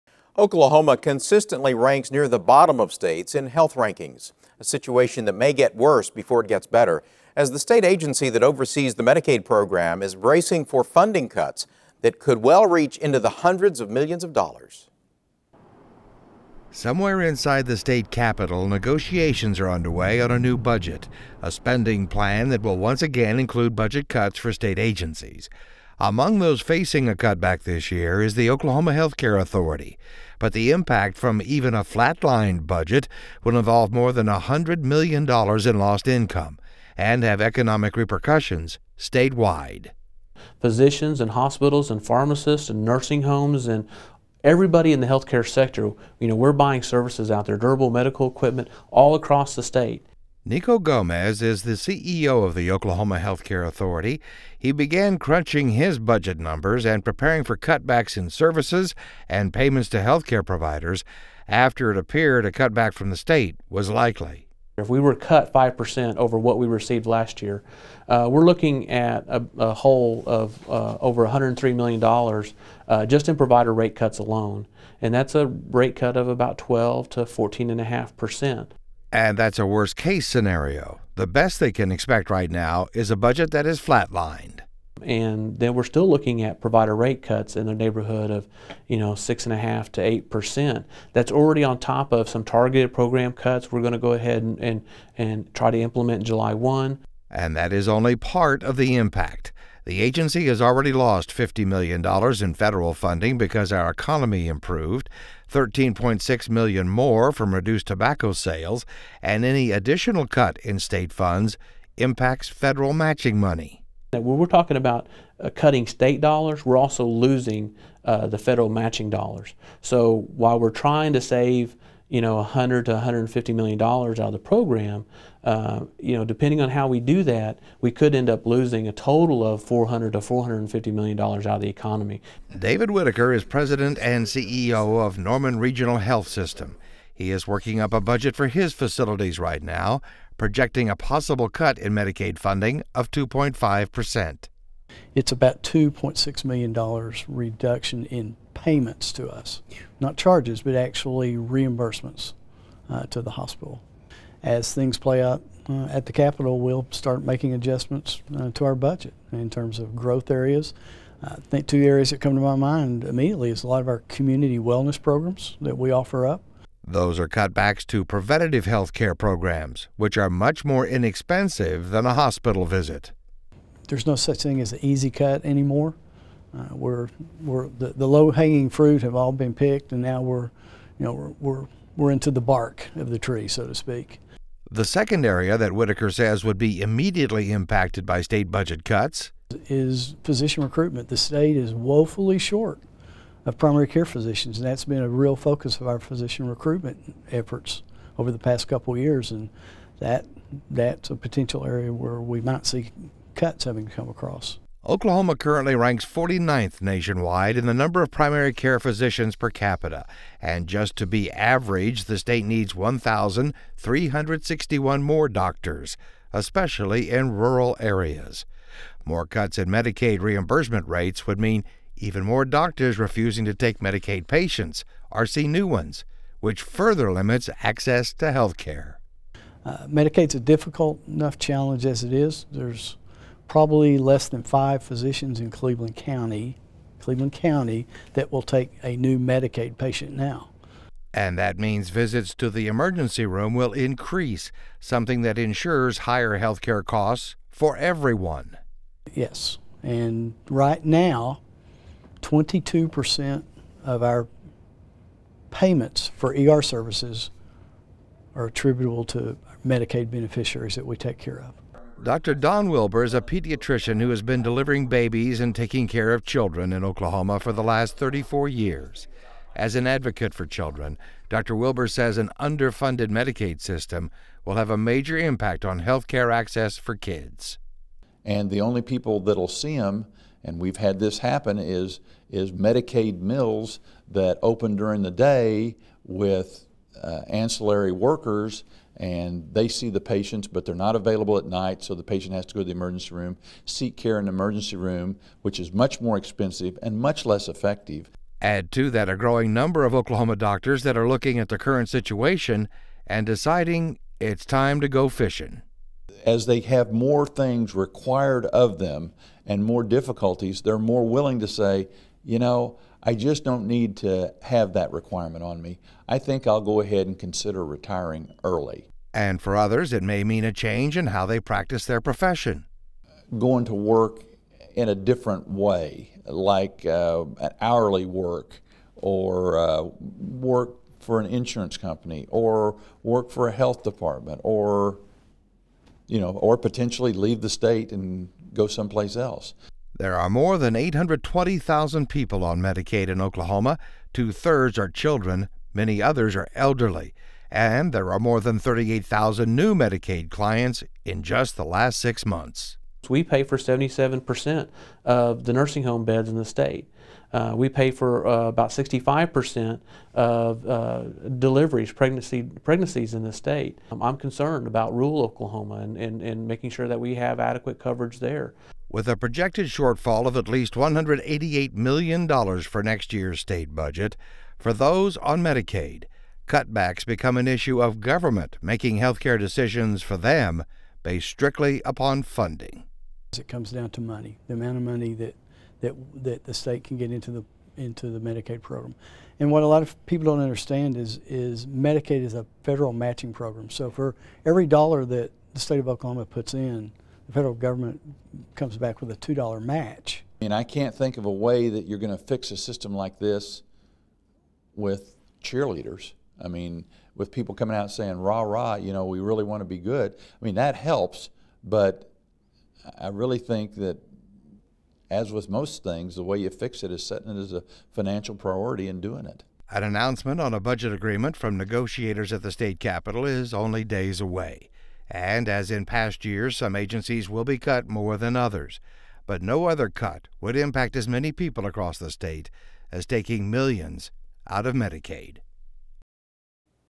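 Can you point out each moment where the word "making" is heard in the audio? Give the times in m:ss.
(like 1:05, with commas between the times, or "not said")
2:37, 6:06, 6:18.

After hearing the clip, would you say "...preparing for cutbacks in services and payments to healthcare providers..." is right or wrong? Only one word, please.
right.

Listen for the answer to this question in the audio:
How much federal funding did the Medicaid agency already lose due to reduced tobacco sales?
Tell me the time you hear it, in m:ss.
1:45.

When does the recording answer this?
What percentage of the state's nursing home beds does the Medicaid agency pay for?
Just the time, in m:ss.
5:53.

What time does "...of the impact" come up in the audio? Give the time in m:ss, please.
1:38.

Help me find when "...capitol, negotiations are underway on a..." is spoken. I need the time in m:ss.
0:18.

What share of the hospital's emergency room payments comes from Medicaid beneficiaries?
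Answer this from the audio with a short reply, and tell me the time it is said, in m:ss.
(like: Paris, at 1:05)
22%, at 4:12.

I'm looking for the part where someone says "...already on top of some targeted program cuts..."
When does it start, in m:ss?
1:31.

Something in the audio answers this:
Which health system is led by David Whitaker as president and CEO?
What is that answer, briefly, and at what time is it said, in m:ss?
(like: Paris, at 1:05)
Norman Regional Health System, at 2:15.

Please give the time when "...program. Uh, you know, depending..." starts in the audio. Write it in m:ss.
2:04.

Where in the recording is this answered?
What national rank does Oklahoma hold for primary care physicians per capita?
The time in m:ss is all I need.
3:26.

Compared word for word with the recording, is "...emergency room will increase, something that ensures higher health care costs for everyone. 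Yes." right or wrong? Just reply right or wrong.
right.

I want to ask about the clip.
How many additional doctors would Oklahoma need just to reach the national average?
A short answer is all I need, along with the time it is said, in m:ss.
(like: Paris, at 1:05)
1,361, at 3:32.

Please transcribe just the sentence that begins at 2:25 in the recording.
It's about $2.6 million reduction in payments to us, not charges, but actually reimbursements uh, to the hospital.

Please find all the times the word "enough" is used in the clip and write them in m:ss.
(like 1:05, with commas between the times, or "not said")
3:51.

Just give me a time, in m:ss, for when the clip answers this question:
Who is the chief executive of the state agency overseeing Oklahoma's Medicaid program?
0:50.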